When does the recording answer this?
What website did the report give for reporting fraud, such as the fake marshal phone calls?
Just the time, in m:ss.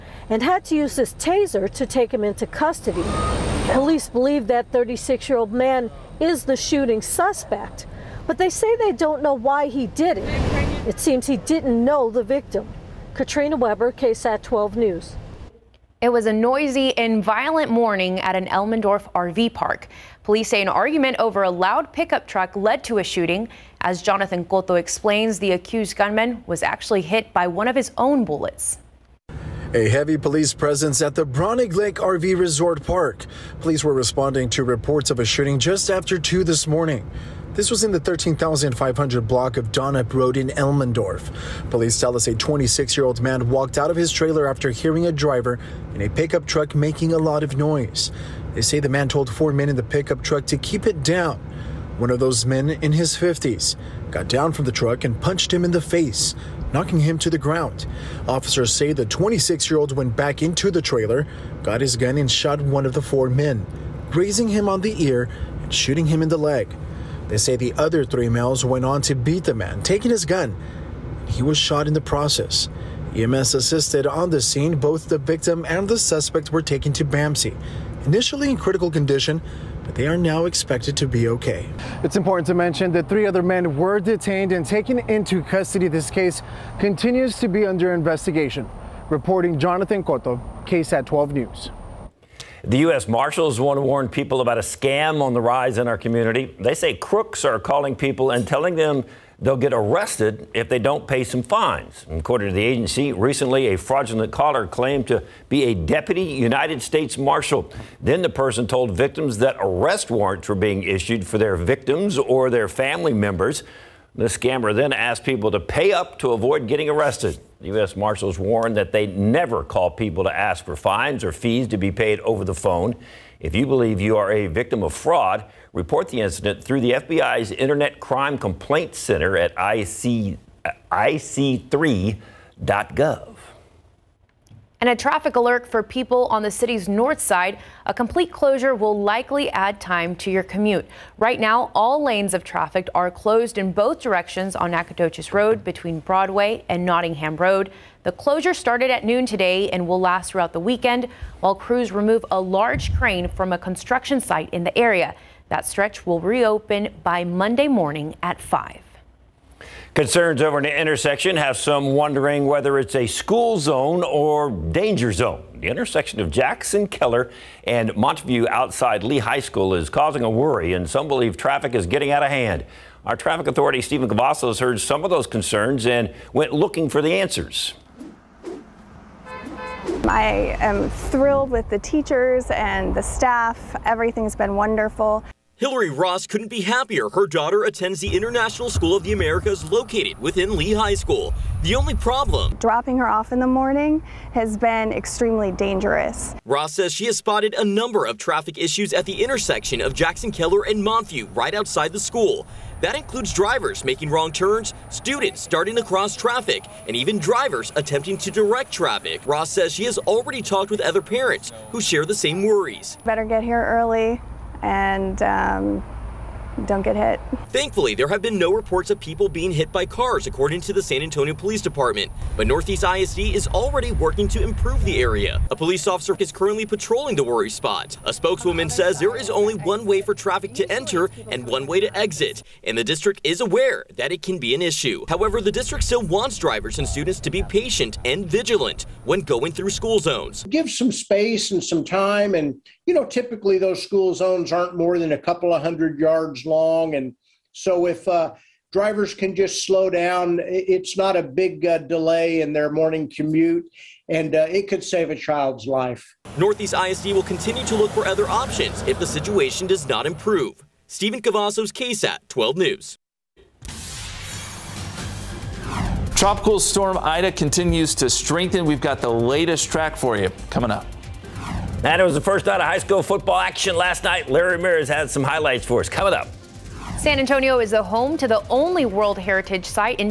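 2:10.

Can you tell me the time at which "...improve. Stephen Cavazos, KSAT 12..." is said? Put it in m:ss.
4:20.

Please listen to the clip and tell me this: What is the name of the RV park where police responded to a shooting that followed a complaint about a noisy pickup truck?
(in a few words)
Braunig Lake RV Resort Park.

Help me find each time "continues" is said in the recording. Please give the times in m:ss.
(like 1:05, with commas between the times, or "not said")
1:26, 4:17, 4:27.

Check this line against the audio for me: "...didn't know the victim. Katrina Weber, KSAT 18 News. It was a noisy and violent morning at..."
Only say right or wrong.
wrong.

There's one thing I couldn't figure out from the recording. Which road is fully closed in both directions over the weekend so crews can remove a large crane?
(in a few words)
Nacogdoches Road.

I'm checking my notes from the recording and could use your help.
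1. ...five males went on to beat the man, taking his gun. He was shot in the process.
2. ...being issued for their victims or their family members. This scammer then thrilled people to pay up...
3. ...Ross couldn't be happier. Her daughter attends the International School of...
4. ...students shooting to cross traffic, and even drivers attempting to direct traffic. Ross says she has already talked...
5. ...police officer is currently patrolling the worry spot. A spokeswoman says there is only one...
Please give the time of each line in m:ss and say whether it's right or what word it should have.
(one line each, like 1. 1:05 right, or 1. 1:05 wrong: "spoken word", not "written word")
1. 1:08 wrong: "three", not "five"
2. 1:50 wrong: "asked", not "thrilled"
3. 3:05 right
4. 3:24 wrong: "starting", not "shooting"
5. 3:45 right.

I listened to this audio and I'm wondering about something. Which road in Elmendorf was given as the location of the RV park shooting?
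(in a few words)
Donop Road.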